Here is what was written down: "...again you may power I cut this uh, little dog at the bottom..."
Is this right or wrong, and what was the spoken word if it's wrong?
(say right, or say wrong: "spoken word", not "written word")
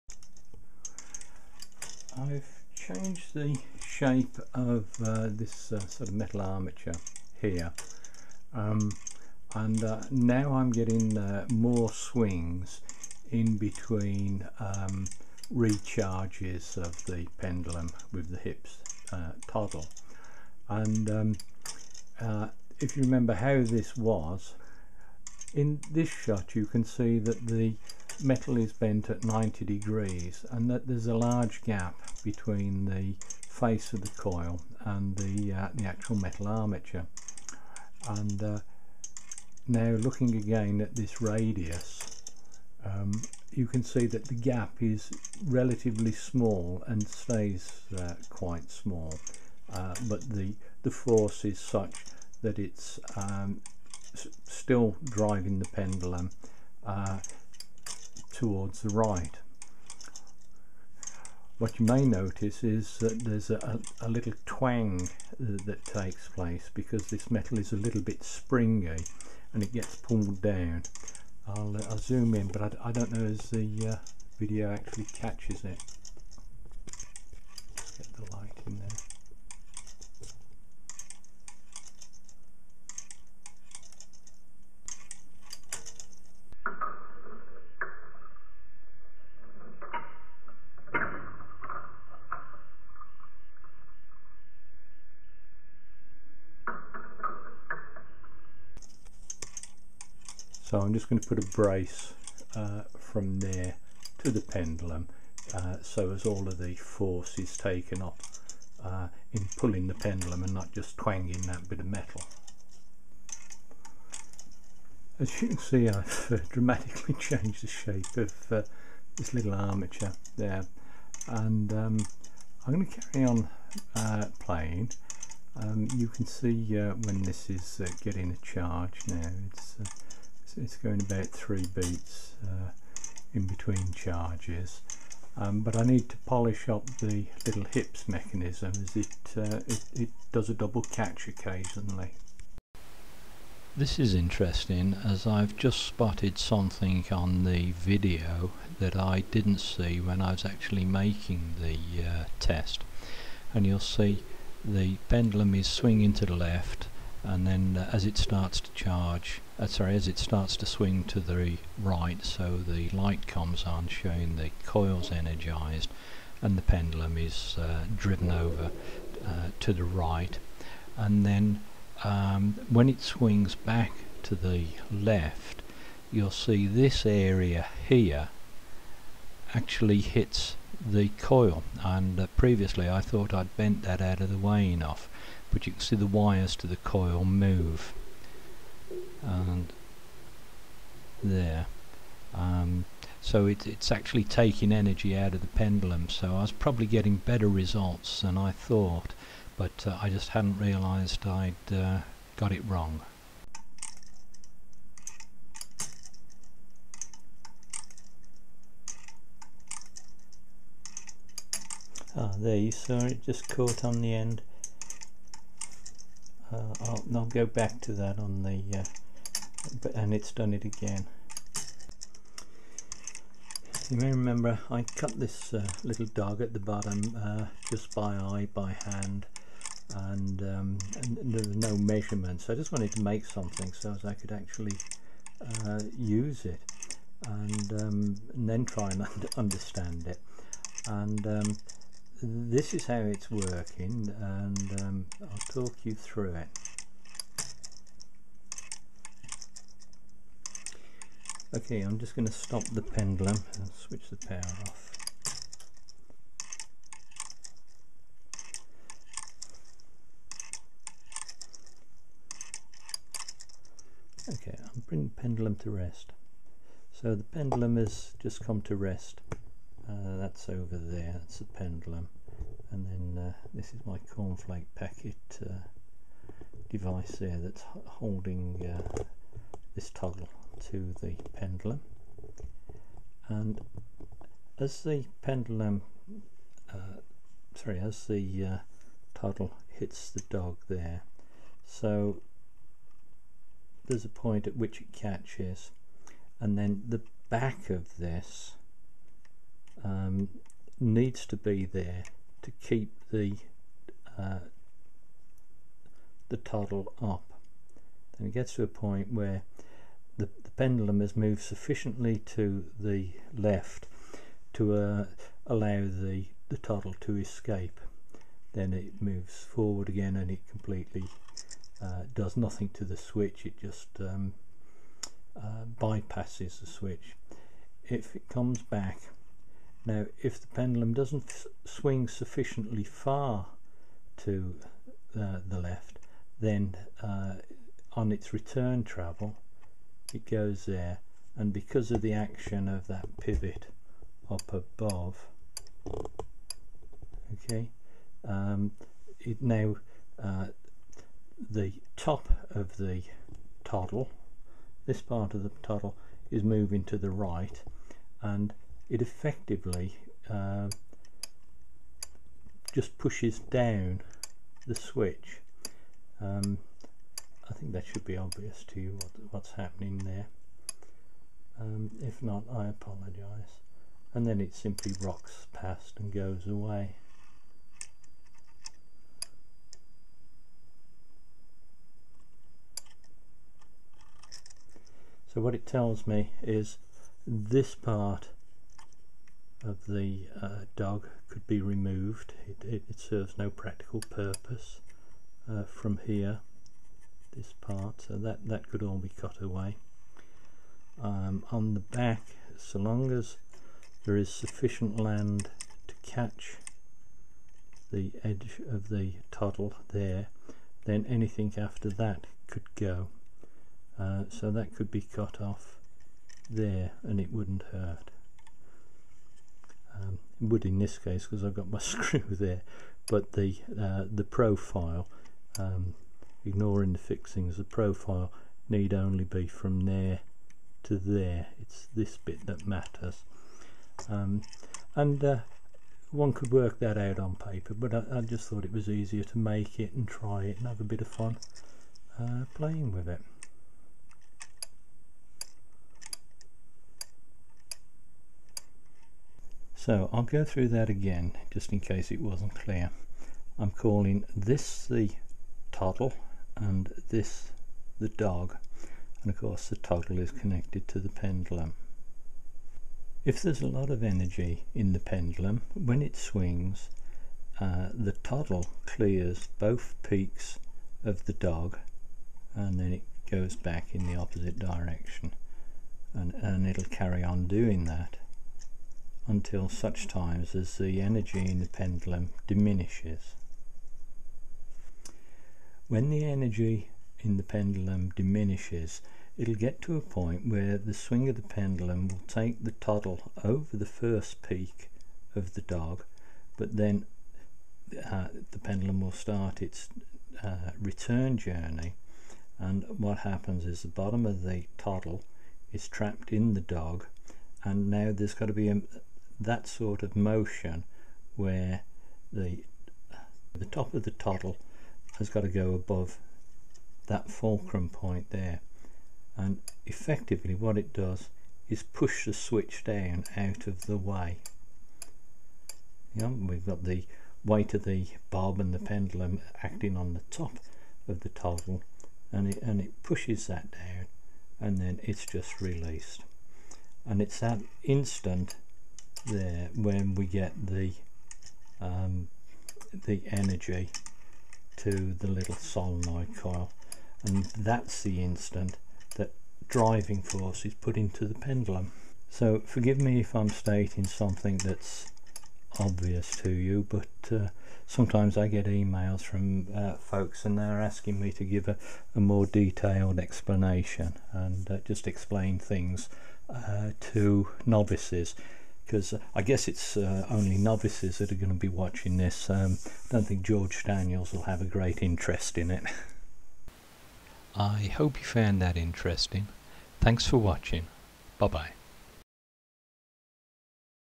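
wrong: "remember", not "power".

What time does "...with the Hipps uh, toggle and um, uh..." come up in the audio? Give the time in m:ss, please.
0:18.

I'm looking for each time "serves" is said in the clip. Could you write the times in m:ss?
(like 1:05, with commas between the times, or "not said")
6:32.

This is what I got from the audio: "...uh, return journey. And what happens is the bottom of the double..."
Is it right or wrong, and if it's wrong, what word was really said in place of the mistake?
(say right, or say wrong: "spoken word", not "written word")
wrong: "toggle", not "double".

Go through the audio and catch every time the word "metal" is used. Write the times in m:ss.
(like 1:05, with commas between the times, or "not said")
0:06, 0:28, 0:36, 1:07, 1:51.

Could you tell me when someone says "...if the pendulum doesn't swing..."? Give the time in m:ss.
5:30.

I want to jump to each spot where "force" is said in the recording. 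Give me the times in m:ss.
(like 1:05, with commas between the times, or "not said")
0:50, 1:46, 9:10.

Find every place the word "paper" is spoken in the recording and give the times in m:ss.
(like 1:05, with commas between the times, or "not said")
7:17.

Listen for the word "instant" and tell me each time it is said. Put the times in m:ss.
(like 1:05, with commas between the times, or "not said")
8:57, 9:08.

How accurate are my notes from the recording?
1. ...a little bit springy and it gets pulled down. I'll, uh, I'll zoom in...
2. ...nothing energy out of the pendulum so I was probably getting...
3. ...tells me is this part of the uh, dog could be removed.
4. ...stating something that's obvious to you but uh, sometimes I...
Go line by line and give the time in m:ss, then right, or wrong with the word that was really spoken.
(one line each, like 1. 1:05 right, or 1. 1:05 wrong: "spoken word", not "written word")
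1. 1:07 right
2. 3:14 wrong: "taking", not "nothing"
3. 6:25 right
4. 9:13 right.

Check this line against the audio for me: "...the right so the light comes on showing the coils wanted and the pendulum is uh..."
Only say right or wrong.
wrong.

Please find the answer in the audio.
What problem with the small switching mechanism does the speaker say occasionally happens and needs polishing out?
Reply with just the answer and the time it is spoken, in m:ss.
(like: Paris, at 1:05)
Double catch, at 2:20.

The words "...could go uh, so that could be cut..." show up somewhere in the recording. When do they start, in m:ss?
6:52.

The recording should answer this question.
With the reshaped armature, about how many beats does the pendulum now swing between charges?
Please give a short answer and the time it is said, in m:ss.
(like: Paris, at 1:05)
3 beats, at 2:11.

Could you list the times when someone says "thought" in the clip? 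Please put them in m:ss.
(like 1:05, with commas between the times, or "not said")
3:03, 3:18, 7:18.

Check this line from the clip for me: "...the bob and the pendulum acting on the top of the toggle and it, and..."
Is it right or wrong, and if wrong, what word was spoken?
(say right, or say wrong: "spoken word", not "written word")
right.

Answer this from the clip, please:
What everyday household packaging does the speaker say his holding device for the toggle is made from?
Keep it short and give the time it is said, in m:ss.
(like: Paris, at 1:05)
Cornflake packet, at 4:34.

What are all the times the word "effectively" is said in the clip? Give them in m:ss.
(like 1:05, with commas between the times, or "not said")
5:59, 8:39.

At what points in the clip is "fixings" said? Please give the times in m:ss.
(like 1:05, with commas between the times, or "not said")
7:06.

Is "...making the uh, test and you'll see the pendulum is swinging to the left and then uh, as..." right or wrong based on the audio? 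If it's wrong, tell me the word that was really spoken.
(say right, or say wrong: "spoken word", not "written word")
right.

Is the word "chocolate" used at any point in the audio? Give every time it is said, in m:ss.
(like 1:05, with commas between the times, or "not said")
not said.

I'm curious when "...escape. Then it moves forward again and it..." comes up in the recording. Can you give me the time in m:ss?
5:17.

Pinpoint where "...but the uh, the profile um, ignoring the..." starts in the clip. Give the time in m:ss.
7:03.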